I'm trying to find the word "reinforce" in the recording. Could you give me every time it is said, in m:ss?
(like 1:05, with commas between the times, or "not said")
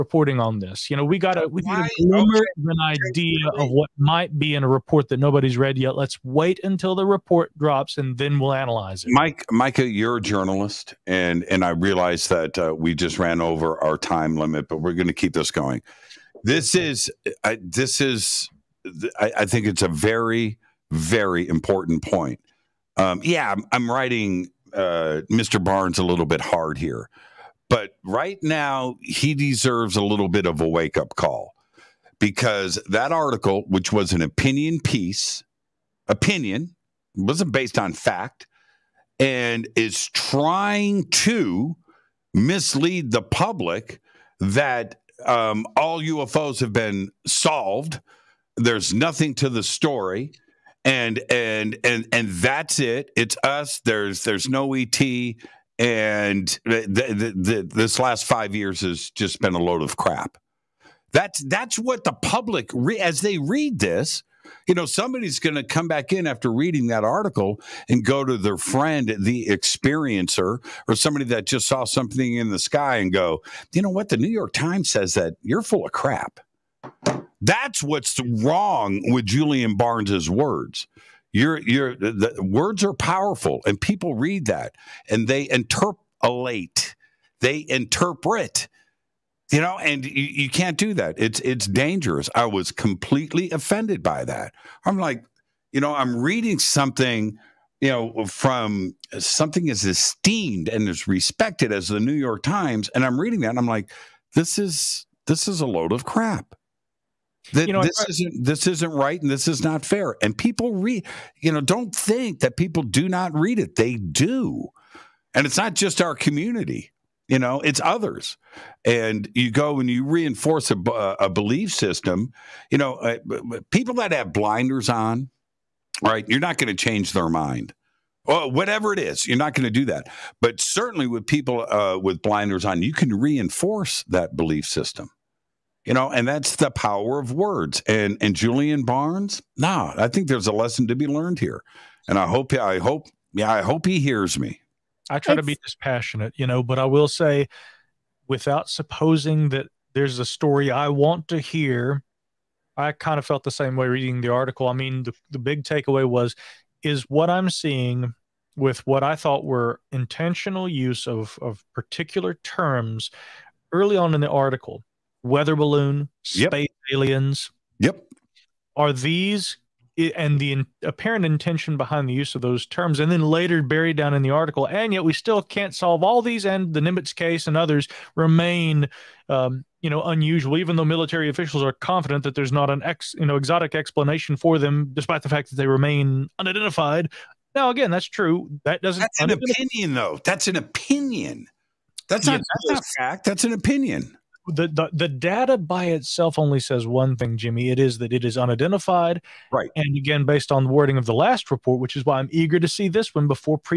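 2:00, 2:13.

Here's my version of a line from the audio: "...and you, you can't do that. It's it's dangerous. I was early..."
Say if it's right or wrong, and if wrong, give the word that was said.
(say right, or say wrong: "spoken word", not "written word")
wrong: "completely", not "early".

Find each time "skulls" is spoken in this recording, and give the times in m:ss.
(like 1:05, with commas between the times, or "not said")
not said.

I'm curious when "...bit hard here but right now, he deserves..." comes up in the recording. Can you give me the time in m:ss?
0:26.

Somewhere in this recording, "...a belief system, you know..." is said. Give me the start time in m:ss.
2:01.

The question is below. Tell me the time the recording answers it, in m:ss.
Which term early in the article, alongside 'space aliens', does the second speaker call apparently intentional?
2:45.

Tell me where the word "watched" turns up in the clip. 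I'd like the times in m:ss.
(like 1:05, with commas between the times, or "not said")
not said.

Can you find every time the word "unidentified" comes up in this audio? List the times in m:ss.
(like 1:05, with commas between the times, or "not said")
3:06, 3:18.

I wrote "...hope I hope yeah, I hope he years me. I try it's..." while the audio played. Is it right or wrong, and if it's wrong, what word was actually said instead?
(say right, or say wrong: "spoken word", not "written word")
wrong: "hears", not "years".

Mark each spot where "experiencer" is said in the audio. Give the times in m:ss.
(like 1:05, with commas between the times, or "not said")
1:09.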